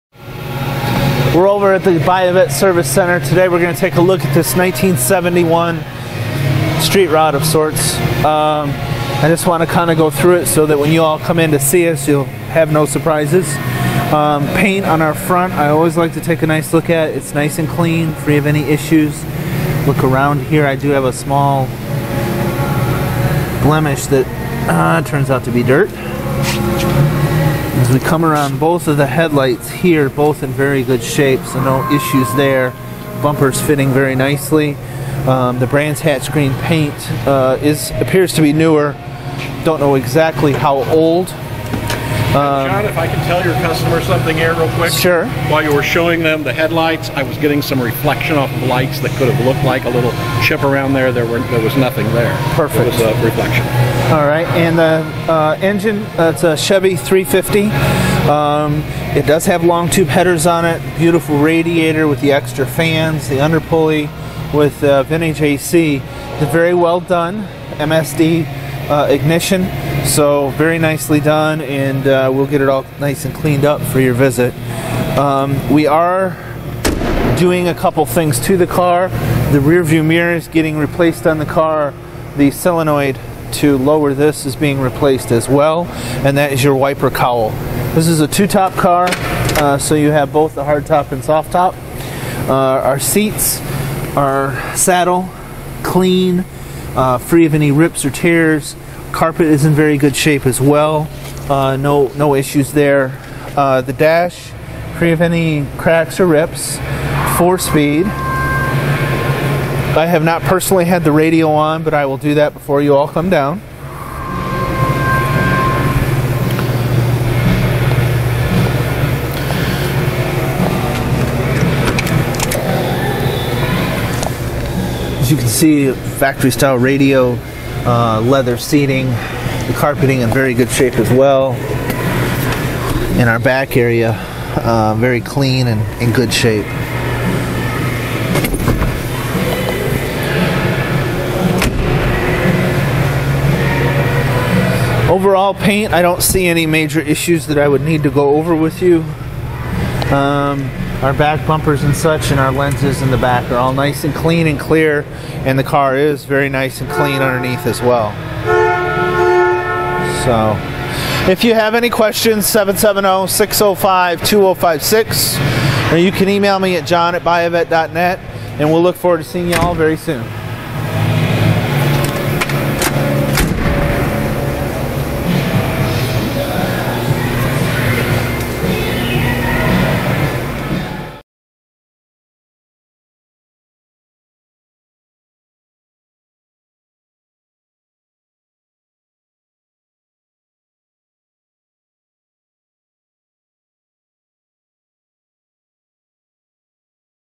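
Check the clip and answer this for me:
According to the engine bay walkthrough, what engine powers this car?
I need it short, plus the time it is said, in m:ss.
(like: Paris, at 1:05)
Chevy 350, at 0:56.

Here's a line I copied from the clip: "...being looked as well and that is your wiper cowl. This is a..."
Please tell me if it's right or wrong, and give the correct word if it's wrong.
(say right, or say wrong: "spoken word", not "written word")
wrong: "replaced", not "looked".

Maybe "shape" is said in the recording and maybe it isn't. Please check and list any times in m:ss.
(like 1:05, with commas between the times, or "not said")
0:31, 1:40, 2:10, 2:16.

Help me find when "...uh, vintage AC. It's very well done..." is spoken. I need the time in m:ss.
1:04.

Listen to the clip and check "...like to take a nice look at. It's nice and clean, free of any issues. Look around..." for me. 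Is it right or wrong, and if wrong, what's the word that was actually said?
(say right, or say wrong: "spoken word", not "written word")
right.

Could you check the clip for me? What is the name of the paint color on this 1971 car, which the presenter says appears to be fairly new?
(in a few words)
Brands Hatch Green.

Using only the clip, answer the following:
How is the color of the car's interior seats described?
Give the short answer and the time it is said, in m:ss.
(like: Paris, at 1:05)
Saddle, at 1:34.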